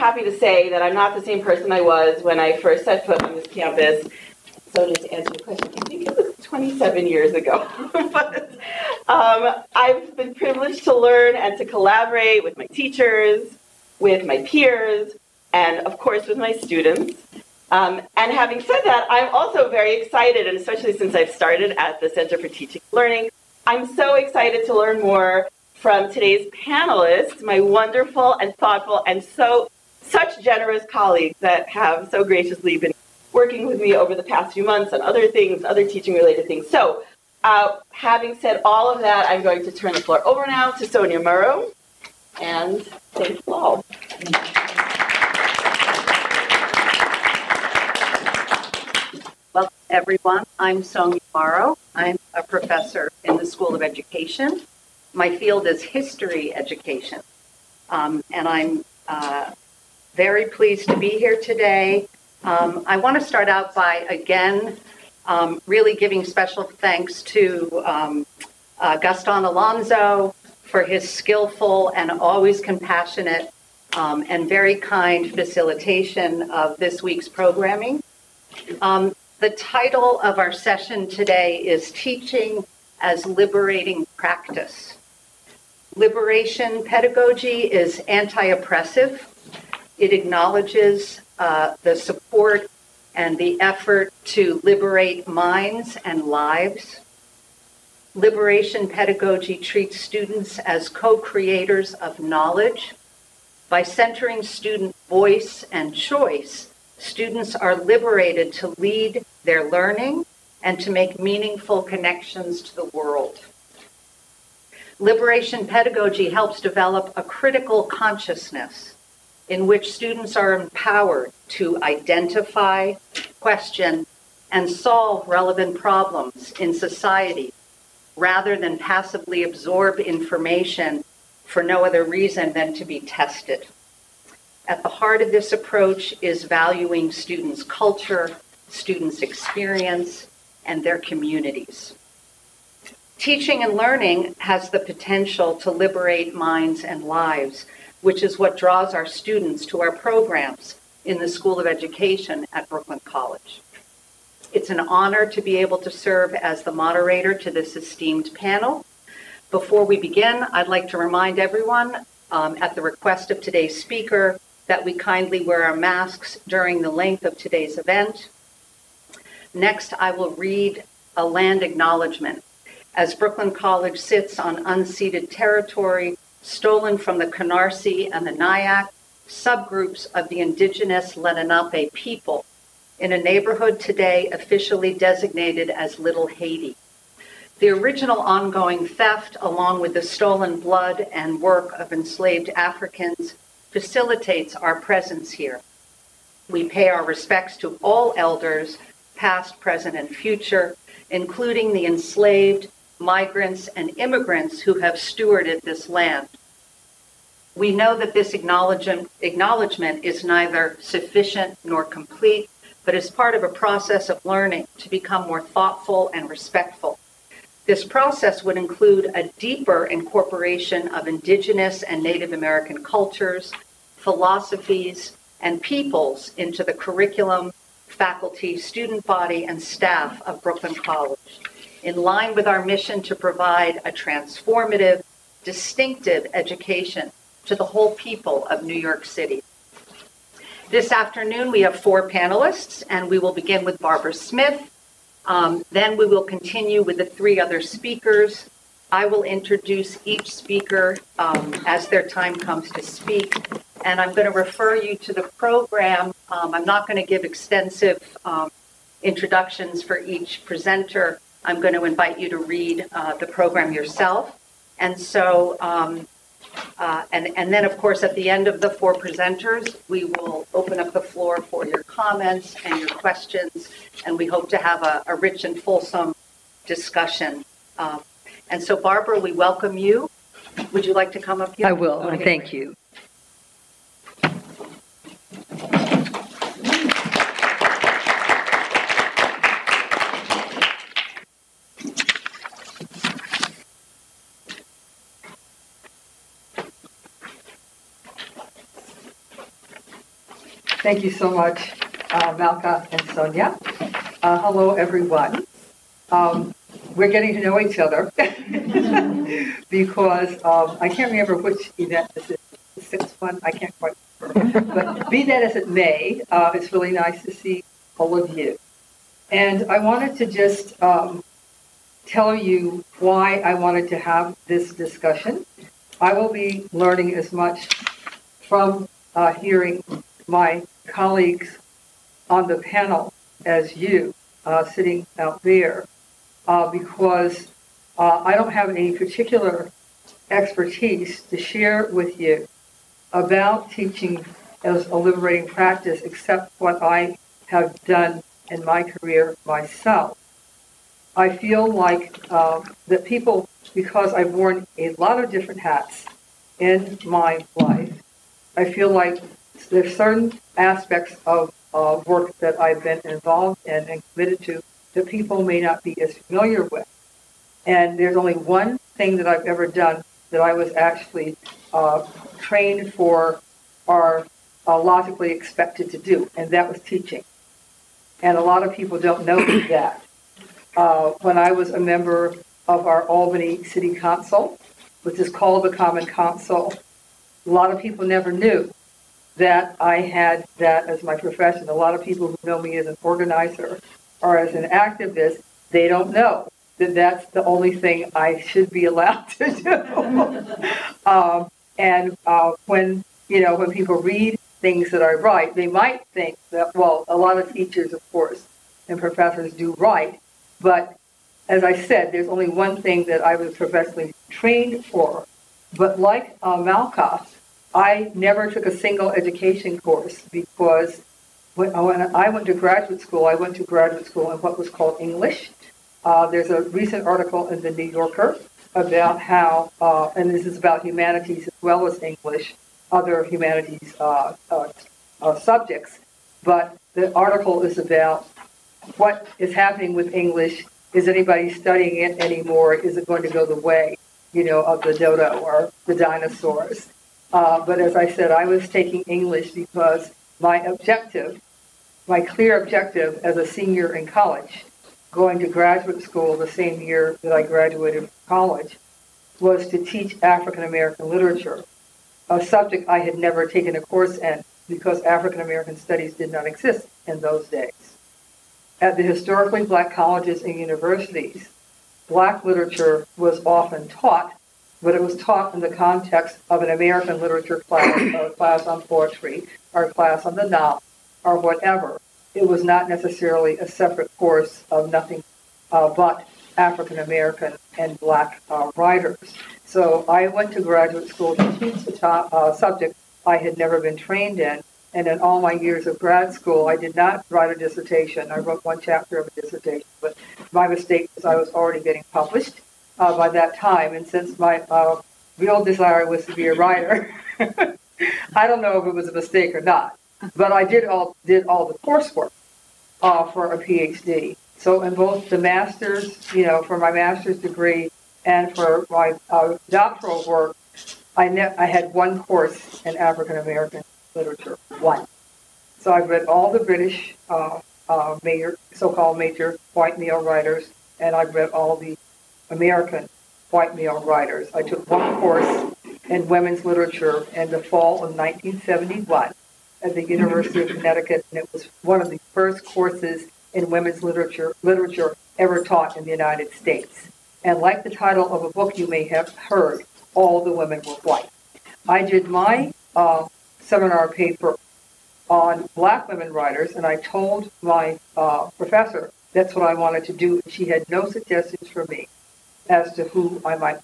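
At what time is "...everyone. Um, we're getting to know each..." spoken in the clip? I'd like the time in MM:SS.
05:04.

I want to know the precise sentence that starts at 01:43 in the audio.
By centering student voice and choice, students are liberated to lead their learning and to make meaningful connections to the world.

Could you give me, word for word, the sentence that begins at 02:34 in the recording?
It's an honor to be able to serve as the moderator to this esteemed panel.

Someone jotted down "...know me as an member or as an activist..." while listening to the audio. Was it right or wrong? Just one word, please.
wrong.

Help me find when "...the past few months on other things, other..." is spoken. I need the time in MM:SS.
00:34.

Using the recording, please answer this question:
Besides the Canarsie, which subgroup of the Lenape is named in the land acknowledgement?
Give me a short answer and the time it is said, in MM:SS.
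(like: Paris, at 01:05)
Nyack, at 02:58.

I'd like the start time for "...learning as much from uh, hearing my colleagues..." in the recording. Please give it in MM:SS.
05:26.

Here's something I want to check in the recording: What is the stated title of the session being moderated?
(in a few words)
Teaching as Liberating Practice.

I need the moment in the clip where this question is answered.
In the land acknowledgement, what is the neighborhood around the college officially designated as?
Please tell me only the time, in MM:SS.
03:05.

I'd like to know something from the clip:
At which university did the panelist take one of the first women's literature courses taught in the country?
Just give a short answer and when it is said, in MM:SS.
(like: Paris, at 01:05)
University of Connecticut, at 09:00.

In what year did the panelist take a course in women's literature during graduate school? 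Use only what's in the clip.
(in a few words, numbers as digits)
1971.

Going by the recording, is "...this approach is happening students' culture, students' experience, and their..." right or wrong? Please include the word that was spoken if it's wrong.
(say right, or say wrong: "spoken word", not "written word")
wrong: "valuing", not "happening".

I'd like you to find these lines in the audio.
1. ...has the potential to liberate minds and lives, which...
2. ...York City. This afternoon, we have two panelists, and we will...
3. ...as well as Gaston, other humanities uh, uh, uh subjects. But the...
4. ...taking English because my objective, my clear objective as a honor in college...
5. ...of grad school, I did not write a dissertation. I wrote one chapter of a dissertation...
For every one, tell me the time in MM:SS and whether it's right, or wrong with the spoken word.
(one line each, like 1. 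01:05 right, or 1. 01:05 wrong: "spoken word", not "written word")
1. 02:24 right
2. 03:58 wrong: "four", not "two"
3. 07:11 wrong: "English", not "Gaston"
4. 07:28 wrong: "senior", not "honor"
5. 08:15 right.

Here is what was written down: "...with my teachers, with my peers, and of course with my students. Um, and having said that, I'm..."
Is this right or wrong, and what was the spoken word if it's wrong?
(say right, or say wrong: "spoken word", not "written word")
right.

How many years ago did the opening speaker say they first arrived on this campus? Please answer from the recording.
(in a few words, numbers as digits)
27.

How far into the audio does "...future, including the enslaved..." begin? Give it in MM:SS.
03:20.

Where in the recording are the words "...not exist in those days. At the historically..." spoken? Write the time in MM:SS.
07:46.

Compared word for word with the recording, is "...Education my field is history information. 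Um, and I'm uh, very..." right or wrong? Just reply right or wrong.
wrong.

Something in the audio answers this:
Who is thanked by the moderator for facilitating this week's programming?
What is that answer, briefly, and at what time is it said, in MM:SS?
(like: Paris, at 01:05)
Gaston Alonso, at 01:08.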